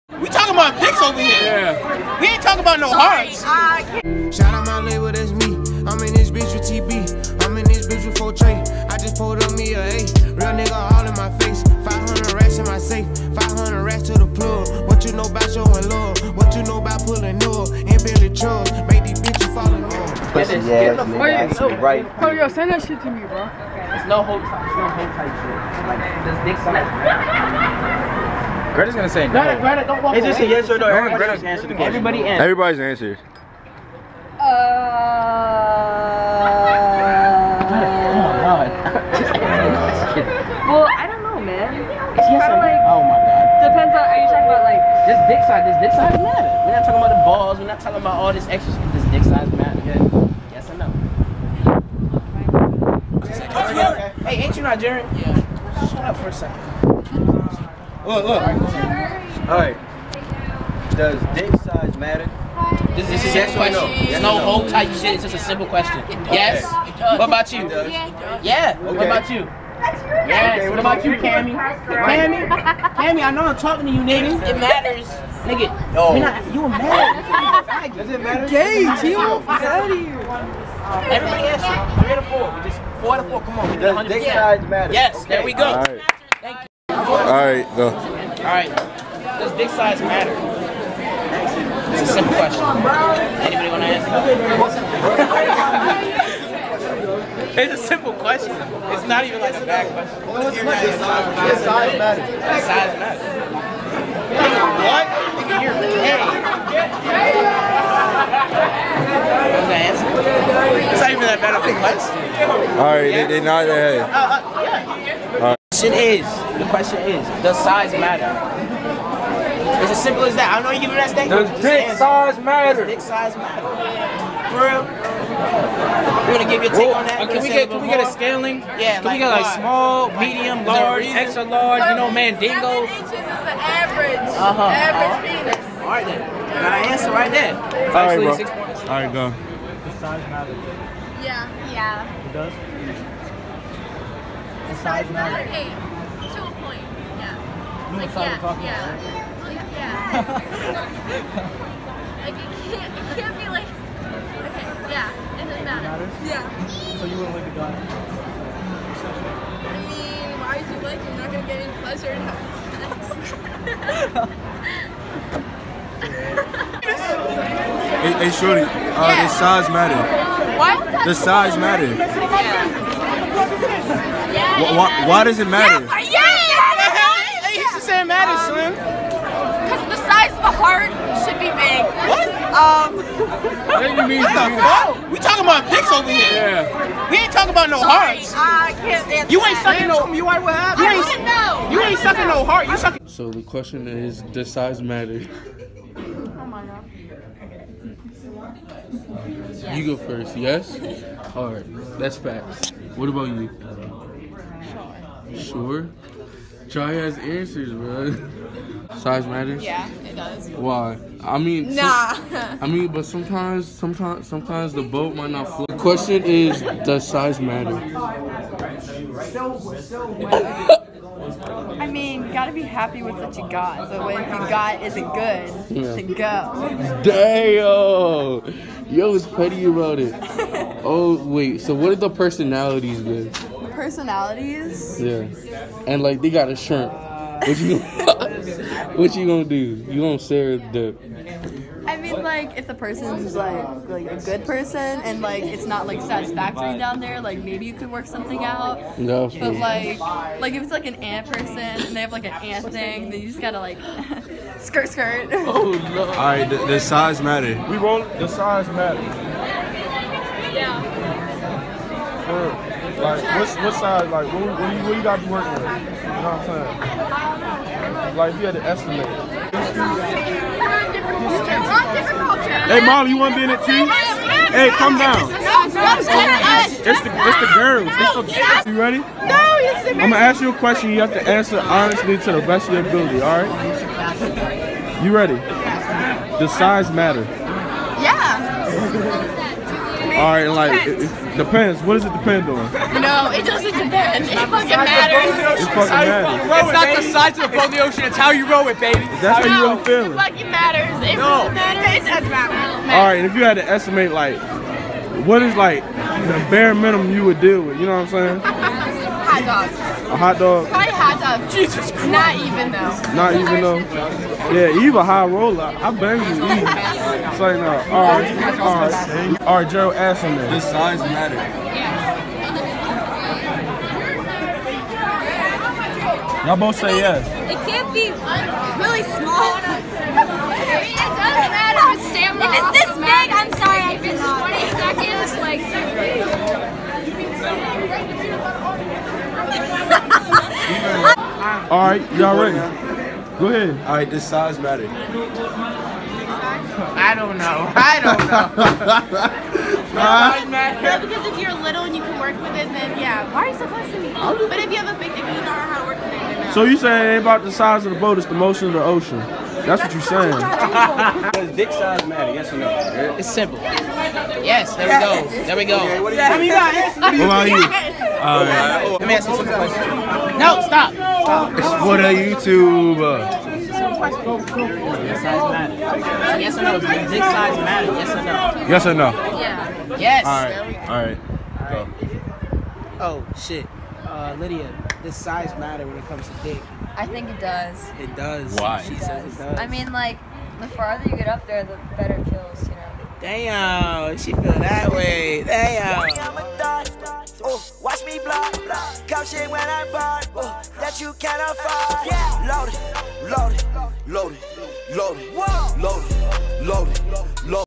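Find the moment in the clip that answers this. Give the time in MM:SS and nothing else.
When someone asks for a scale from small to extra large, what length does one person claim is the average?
02:12.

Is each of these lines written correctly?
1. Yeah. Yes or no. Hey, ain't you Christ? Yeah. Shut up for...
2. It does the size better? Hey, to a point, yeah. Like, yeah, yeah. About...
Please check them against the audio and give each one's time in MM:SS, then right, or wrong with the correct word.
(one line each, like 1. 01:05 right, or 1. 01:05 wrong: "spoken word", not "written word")
1. 00:49 wrong: "Nigerian", not "Christ"
2. 02:22 wrong: "matter", not "better".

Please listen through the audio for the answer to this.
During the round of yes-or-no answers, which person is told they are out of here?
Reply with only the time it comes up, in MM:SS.
01:18.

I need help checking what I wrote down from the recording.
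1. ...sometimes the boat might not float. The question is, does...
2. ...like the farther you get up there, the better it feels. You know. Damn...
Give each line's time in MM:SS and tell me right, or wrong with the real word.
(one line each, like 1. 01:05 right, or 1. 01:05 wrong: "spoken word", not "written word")
1. 03:34 right
2. 06:29 right.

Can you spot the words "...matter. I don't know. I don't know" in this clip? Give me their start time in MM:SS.
05:44.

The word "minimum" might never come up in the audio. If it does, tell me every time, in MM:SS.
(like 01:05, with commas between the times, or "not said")
05:06.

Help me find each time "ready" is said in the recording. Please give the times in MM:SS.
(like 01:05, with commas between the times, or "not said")
04:38, 04:45, 05:42.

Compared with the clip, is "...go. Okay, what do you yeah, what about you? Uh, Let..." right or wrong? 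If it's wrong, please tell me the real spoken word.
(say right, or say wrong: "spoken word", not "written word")
right.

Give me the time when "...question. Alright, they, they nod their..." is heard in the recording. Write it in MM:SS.
01:51.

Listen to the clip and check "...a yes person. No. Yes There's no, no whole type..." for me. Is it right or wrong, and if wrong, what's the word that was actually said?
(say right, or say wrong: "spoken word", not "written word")
wrong: "question", not "person".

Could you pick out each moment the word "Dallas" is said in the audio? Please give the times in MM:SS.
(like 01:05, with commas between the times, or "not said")
not said.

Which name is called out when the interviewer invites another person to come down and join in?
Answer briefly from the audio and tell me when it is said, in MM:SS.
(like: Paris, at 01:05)
Molly, at 04:32.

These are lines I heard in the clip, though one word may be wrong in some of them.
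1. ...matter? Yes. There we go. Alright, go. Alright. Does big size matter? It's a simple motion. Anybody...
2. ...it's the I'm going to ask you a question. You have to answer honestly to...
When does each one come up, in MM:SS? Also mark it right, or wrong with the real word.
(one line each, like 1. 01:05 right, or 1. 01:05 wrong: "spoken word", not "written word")
1. 01:24 wrong: "question", not "motion"
2. 04:39 right.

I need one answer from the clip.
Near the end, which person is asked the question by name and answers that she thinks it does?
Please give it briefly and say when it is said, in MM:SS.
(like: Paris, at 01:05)
Lydia, at 06:24.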